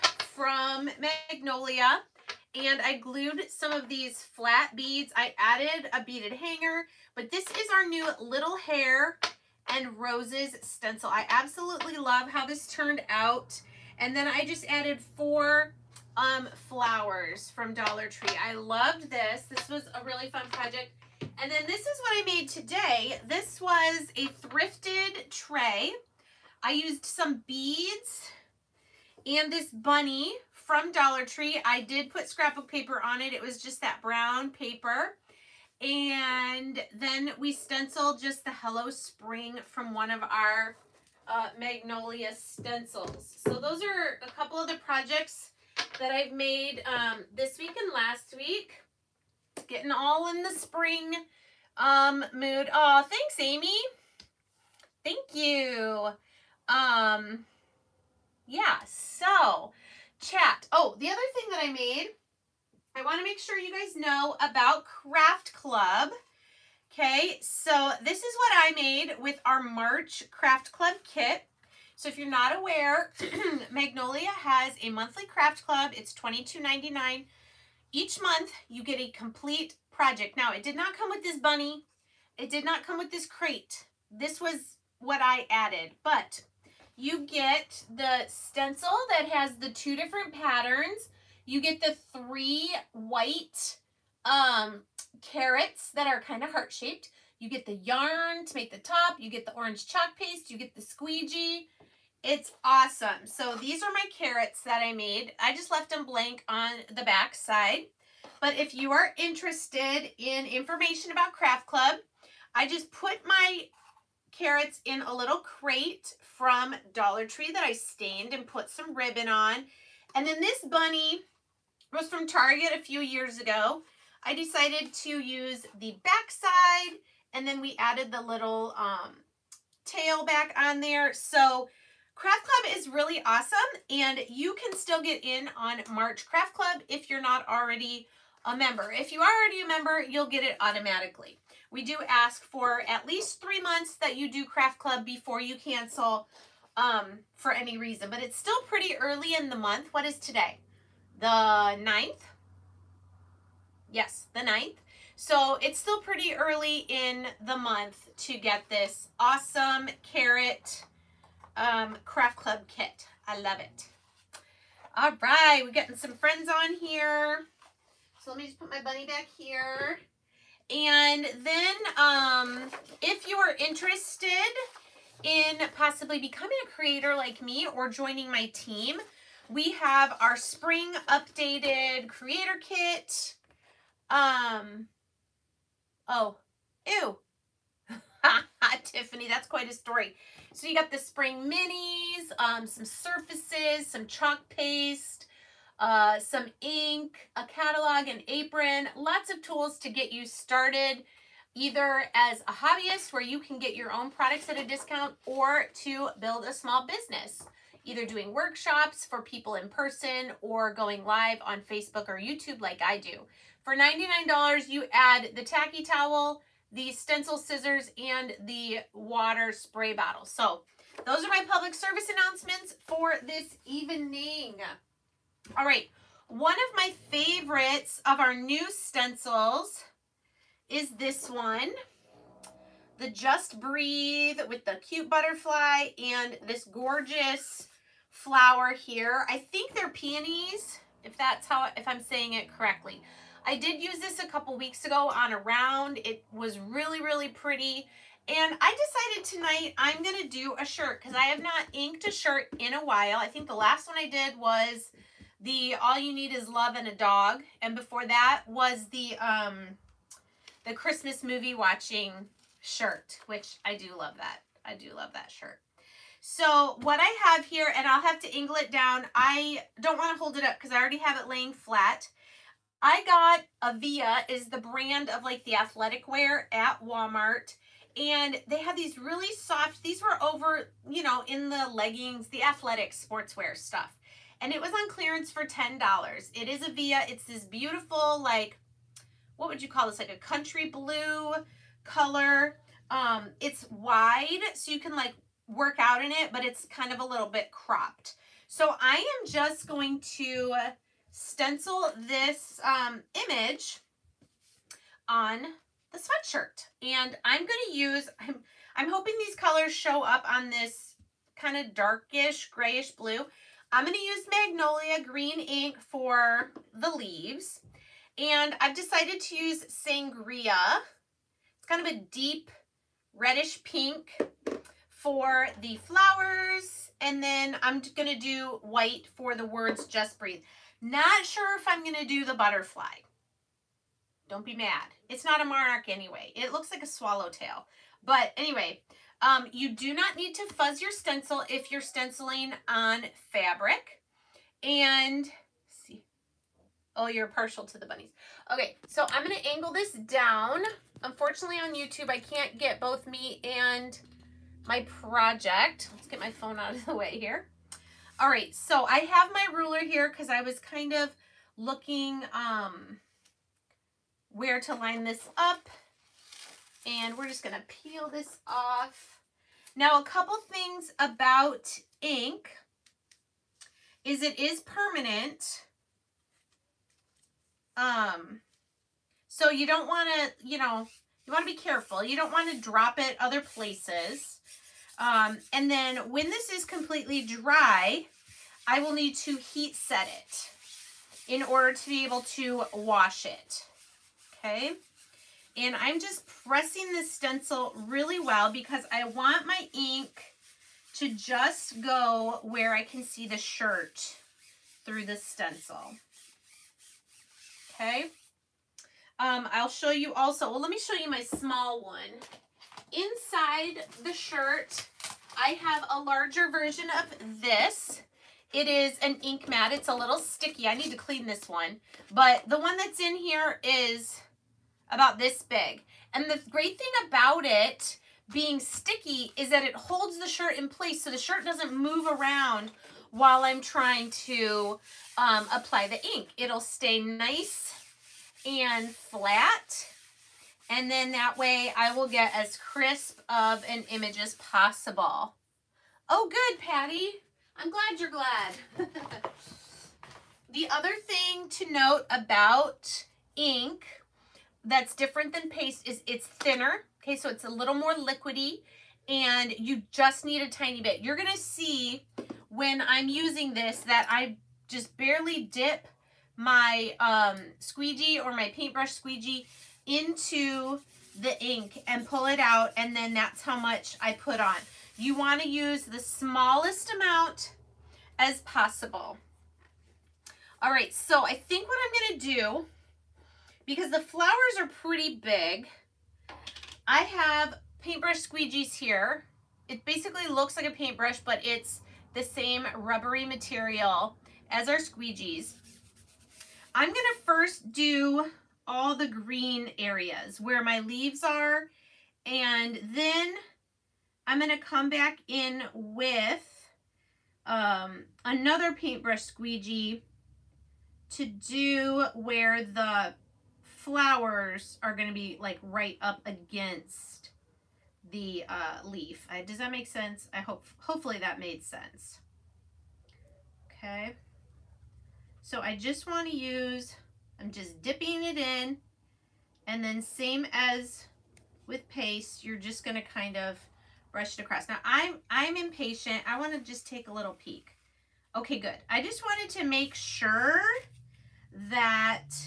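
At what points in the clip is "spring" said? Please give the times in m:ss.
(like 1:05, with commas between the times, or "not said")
0:38, 0:50, 3:00, 3:10.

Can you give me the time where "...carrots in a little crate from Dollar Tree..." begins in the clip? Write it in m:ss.
1:54.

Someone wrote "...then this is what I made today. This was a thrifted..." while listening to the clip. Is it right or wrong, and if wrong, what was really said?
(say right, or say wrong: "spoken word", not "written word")
right.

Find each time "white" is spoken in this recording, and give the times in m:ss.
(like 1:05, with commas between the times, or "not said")
1:32, 5:28.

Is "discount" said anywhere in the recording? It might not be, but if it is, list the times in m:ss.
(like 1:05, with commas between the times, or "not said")
3:24.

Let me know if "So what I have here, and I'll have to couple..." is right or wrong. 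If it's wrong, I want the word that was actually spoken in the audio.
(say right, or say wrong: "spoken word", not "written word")
wrong: "angle", not "couple".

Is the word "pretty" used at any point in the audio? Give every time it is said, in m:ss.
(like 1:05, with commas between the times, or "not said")
2:28, 2:35, 4:07, 8:04.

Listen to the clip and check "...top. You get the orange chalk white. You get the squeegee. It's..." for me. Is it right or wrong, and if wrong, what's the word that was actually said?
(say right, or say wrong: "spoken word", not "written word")
wrong: "paste", not "white".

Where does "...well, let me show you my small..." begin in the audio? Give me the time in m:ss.
6:50.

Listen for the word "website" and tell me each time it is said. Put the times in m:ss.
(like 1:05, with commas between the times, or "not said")
not said.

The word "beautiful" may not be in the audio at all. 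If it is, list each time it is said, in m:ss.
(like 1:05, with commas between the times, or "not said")
4:47.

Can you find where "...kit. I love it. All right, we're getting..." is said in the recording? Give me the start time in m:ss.
2:42.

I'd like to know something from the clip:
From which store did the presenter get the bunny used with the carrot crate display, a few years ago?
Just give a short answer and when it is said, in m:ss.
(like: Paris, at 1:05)
Target, at 2:02.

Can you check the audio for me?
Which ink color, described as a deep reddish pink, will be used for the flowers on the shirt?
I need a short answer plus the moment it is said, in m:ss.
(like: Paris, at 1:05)
Sangria, at 5:19.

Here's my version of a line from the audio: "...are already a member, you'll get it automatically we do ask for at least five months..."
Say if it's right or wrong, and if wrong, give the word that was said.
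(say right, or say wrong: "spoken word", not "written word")
wrong: "three", not "five".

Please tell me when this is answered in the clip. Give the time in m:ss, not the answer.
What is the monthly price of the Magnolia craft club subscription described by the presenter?
1:16.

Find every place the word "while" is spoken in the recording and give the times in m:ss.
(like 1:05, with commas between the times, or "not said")
4:12, 7:13.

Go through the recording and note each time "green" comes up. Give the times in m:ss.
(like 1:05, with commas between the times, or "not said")
5:15, 8:19.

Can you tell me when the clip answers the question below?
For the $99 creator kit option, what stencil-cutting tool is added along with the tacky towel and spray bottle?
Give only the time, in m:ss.
3:36.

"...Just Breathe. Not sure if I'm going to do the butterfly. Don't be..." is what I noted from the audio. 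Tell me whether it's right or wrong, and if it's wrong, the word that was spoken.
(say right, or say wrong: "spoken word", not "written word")
right.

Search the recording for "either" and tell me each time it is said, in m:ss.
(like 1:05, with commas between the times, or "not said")
3:21, 3:27.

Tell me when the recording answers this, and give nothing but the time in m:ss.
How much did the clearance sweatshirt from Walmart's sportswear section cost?
4:45.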